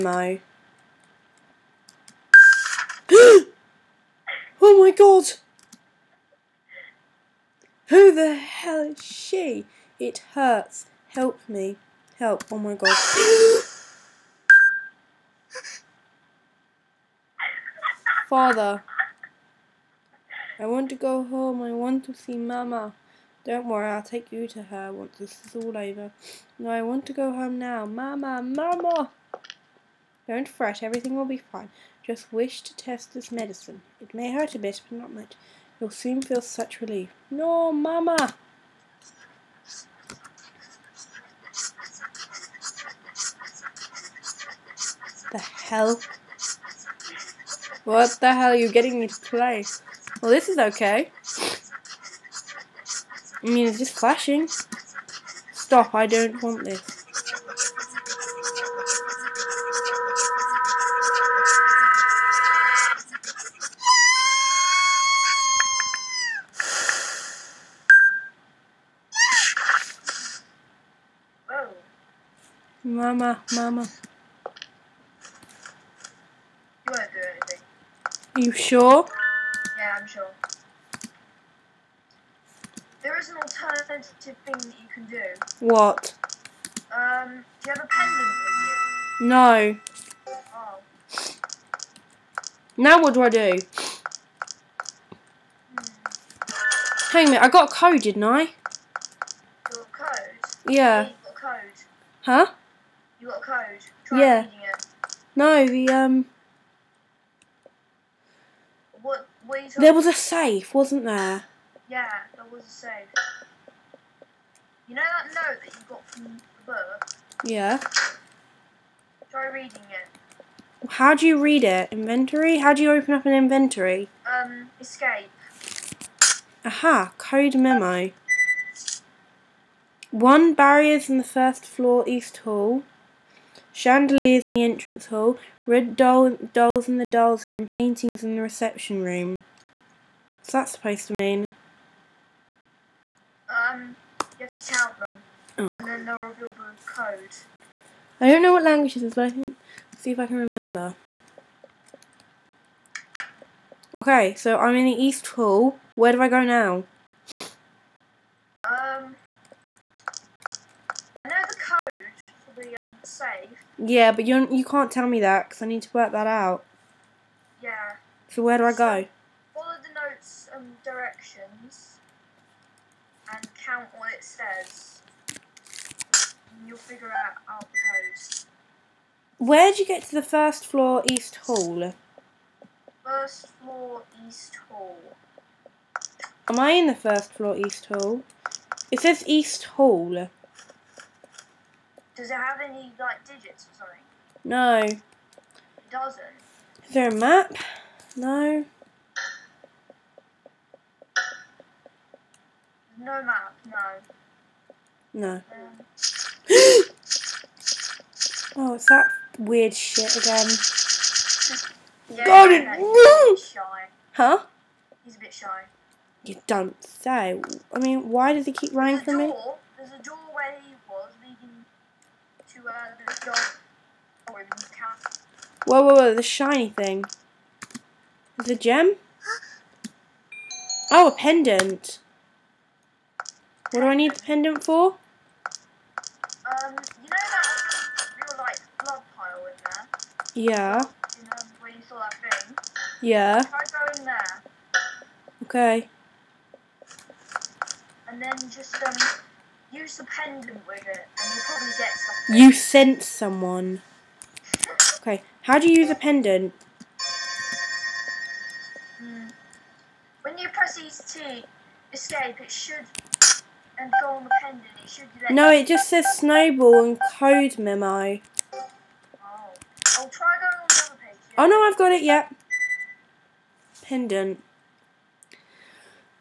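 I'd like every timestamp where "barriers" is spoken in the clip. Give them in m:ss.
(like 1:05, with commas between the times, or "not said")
2:10.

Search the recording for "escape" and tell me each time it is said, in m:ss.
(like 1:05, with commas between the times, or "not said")
2:04, 4:21.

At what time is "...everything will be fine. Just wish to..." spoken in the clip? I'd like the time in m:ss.
0:30.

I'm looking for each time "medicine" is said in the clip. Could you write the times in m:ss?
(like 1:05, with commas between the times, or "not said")
0:33.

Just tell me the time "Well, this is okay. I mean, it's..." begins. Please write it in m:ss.
0:50.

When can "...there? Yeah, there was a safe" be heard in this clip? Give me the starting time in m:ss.
1:51.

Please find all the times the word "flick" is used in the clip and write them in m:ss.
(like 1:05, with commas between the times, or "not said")
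not said.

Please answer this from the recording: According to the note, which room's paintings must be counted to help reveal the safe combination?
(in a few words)
Reception room.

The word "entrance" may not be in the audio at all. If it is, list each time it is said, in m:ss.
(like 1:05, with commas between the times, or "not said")
2:14.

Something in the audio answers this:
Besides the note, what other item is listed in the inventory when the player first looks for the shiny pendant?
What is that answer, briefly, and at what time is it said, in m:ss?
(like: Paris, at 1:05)
Snowball, at 4:26.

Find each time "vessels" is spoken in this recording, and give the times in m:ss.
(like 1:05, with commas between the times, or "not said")
not said.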